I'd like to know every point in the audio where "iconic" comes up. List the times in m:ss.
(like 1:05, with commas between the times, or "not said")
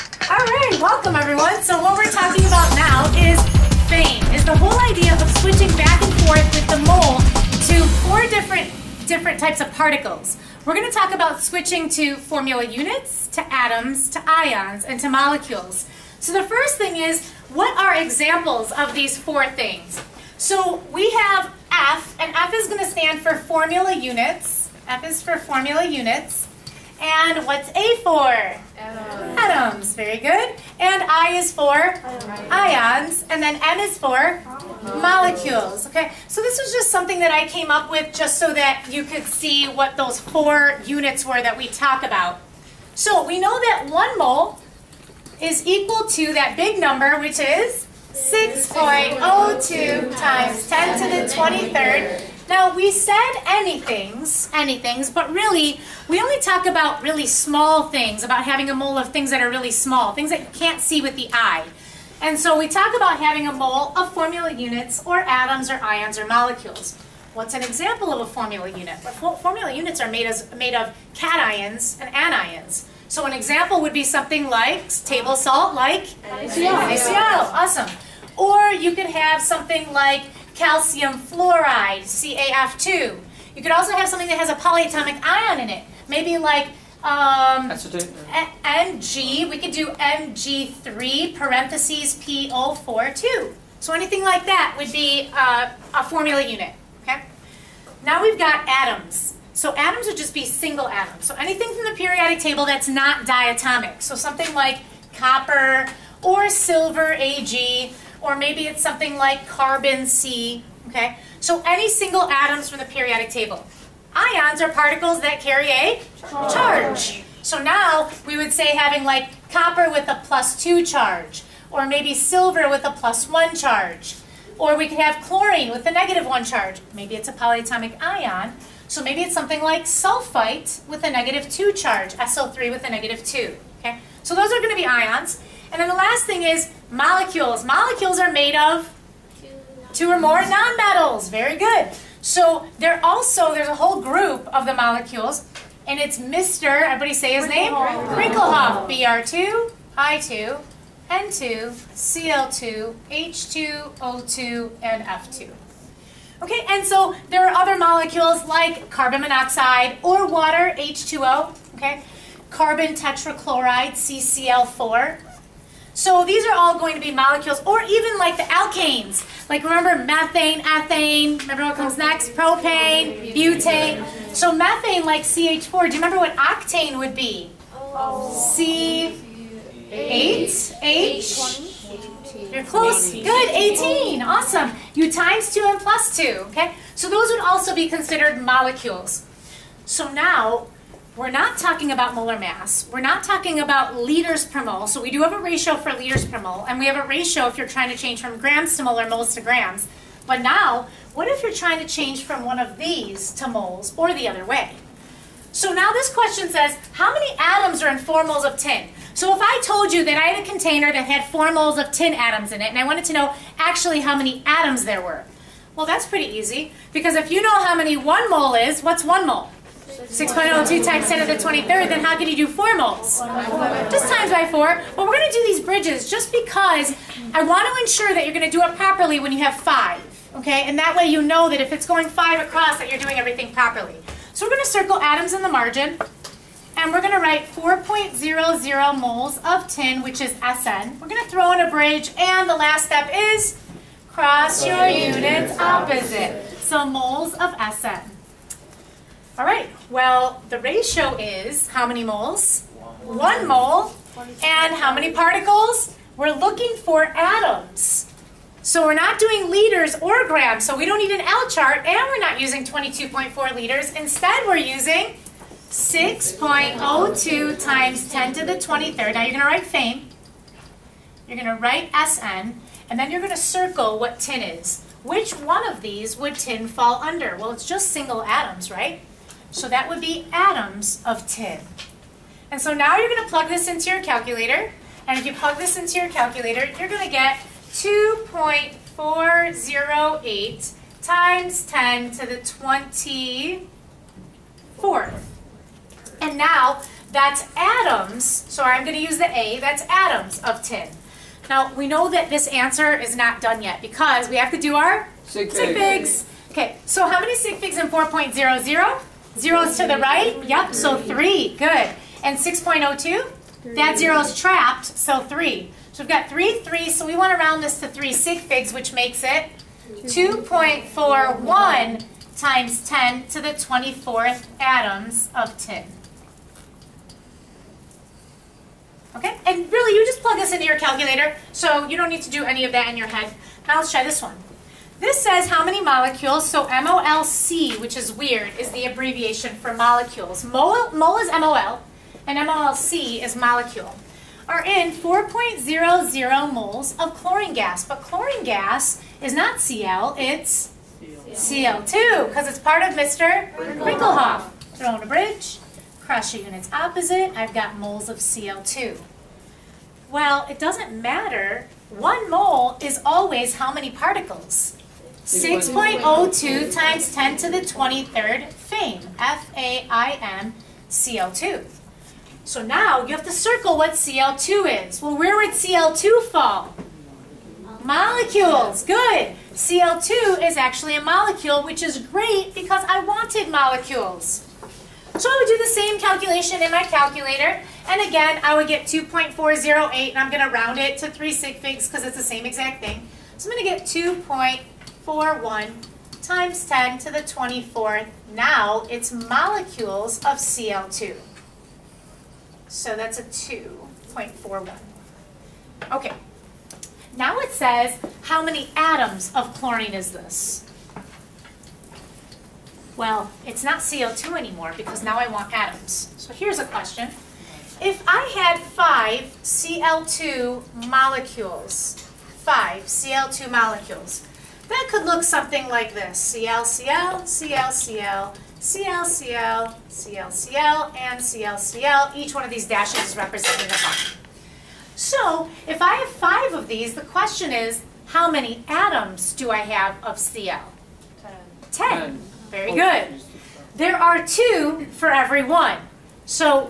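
not said.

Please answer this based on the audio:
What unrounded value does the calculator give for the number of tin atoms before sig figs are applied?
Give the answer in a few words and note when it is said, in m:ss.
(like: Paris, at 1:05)
2.408 times 10 to the 24th, at 4:47.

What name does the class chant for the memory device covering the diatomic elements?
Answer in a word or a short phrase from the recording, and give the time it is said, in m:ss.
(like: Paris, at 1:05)
Wrinklehop, at 2:27.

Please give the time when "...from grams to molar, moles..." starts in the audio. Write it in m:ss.
3:18.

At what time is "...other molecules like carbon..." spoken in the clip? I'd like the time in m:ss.
2:37.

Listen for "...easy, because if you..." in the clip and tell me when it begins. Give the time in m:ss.
3:36.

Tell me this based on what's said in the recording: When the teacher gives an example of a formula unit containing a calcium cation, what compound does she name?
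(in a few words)
calcium fluoride.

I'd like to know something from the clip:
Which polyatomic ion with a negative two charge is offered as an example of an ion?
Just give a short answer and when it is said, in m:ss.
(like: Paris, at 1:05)
sulfite, at 2:09.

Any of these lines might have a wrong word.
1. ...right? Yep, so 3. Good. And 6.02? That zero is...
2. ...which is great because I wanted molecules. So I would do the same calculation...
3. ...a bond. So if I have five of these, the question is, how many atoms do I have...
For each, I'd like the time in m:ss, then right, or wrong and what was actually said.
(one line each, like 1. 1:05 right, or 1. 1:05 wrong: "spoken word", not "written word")
1. 5:09 right
2. 6:21 right
3. 7:13 right.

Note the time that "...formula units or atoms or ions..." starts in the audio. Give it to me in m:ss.
1:04.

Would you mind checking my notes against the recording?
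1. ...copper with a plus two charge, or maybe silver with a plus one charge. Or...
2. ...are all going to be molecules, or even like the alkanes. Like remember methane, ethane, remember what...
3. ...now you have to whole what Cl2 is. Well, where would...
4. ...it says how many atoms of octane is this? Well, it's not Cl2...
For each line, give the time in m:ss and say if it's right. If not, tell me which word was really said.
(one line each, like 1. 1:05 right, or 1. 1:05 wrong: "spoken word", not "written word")
1. 1:59 right
2. 2:46 right
3. 6:12 wrong: "circle", not "whole"
4. 6:47 wrong: "chlorine", not "octane".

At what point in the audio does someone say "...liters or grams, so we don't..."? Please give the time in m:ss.
4:19.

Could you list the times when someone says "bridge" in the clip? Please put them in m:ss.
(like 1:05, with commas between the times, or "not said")
3:45, 4:01, 5:55.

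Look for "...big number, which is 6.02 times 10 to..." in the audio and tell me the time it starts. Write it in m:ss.
0:46.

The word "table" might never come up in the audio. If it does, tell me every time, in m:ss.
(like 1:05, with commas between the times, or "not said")
1:15, 1:42, 1:53.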